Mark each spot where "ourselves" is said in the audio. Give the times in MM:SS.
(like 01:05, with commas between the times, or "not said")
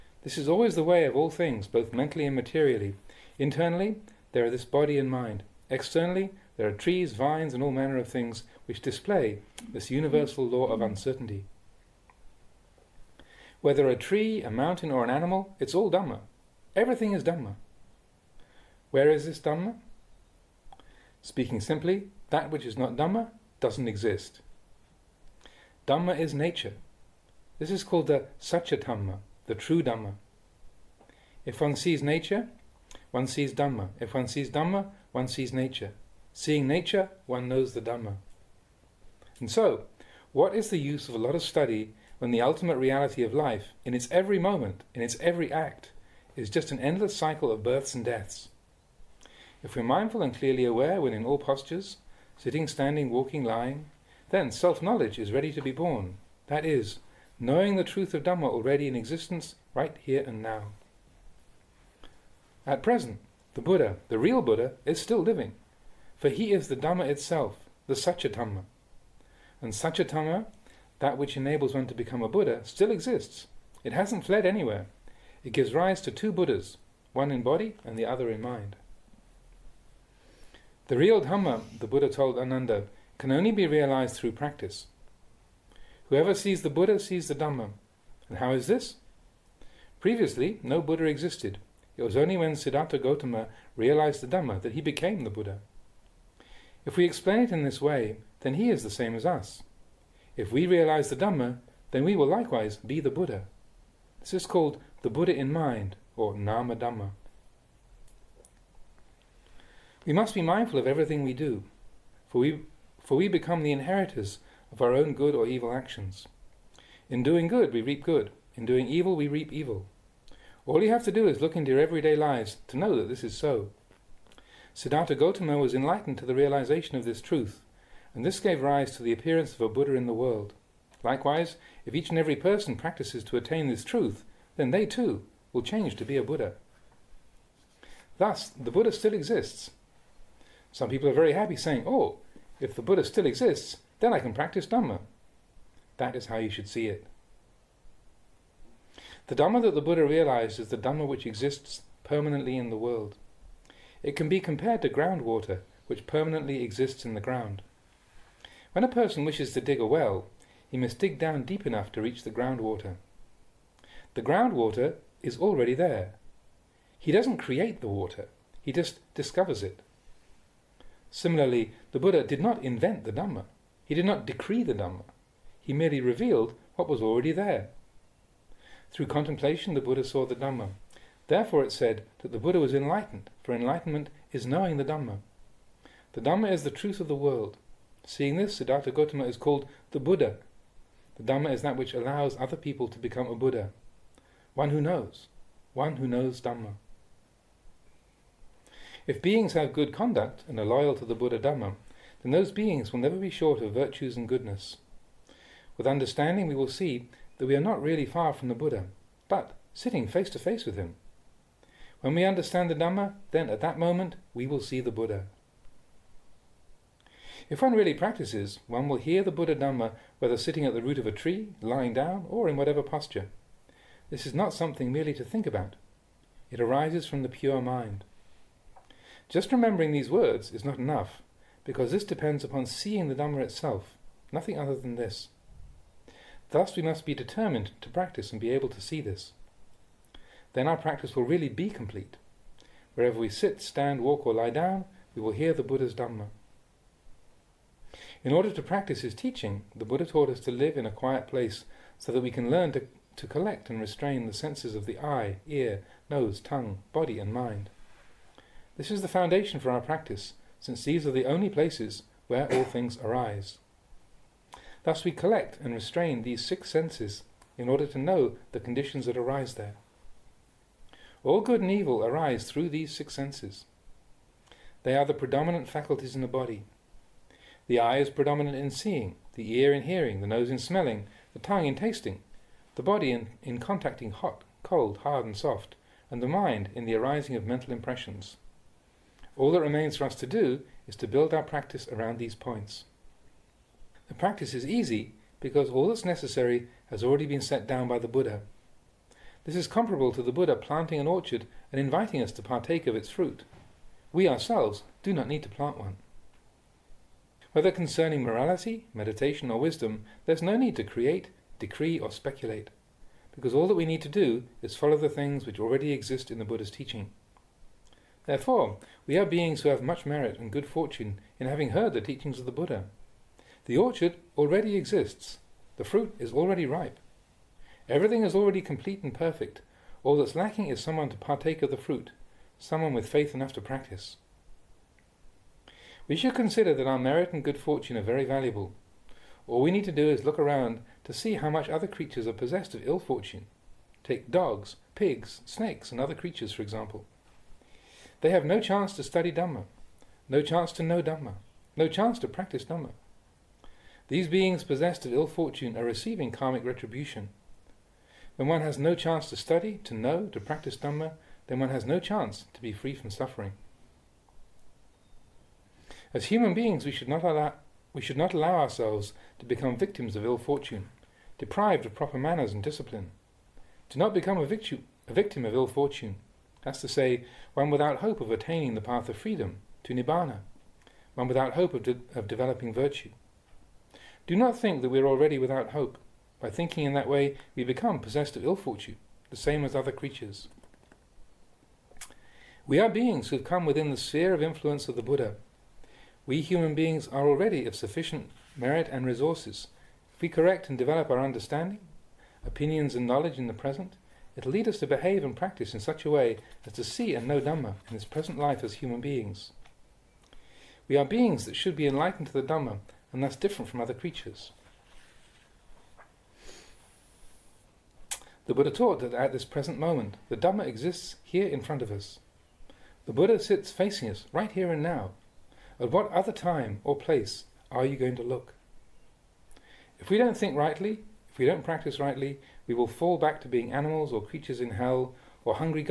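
05:04, 06:08.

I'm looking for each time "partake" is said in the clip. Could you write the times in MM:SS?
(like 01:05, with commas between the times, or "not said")
05:02, 05:31.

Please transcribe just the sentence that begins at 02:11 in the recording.
Likewise, if each and every person practices to attain this truth, then they too will change to be a Buddha.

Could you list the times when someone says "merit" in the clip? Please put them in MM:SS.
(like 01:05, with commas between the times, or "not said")
05:20, 05:36, 06:38.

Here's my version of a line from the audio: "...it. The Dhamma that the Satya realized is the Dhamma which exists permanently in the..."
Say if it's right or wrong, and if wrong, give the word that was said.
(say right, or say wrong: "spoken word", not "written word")
wrong: "Buddha", not "Satya".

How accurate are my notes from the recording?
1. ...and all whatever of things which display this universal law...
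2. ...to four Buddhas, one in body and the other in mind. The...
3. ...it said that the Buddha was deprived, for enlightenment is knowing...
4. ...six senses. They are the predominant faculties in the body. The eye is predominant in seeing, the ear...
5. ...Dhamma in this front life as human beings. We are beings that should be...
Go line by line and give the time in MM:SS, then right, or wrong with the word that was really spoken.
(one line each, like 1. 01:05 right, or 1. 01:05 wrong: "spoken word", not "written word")
1. 00:07 wrong: "manner", not "whatever"
2. 01:16 wrong: "two", not "four"
3. 03:01 wrong: "enlightened", not "deprived"
4. 04:32 right
5. 06:47 wrong: "present", not "front".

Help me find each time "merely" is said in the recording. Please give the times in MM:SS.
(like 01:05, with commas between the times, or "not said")
02:55, 03:44.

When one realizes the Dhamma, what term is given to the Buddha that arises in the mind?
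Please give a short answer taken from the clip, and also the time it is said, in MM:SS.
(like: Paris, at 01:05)
Nama Dhamma, at 01:46.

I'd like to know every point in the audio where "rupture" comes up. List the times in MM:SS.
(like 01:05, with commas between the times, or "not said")
not said.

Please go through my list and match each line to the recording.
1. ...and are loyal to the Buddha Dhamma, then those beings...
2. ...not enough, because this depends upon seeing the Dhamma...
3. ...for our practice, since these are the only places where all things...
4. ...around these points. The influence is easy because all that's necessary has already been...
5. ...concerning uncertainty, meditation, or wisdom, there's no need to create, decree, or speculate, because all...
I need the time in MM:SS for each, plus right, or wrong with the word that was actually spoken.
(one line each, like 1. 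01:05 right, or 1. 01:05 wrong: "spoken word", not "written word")
1. 03:20 right
2. 03:50 right
3. 04:19 right
4. 04:51 wrong: "practice", not "influence"
5. 05:07 wrong: "morality", not "uncertainty".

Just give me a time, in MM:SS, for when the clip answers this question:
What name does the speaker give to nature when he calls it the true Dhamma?
00:28.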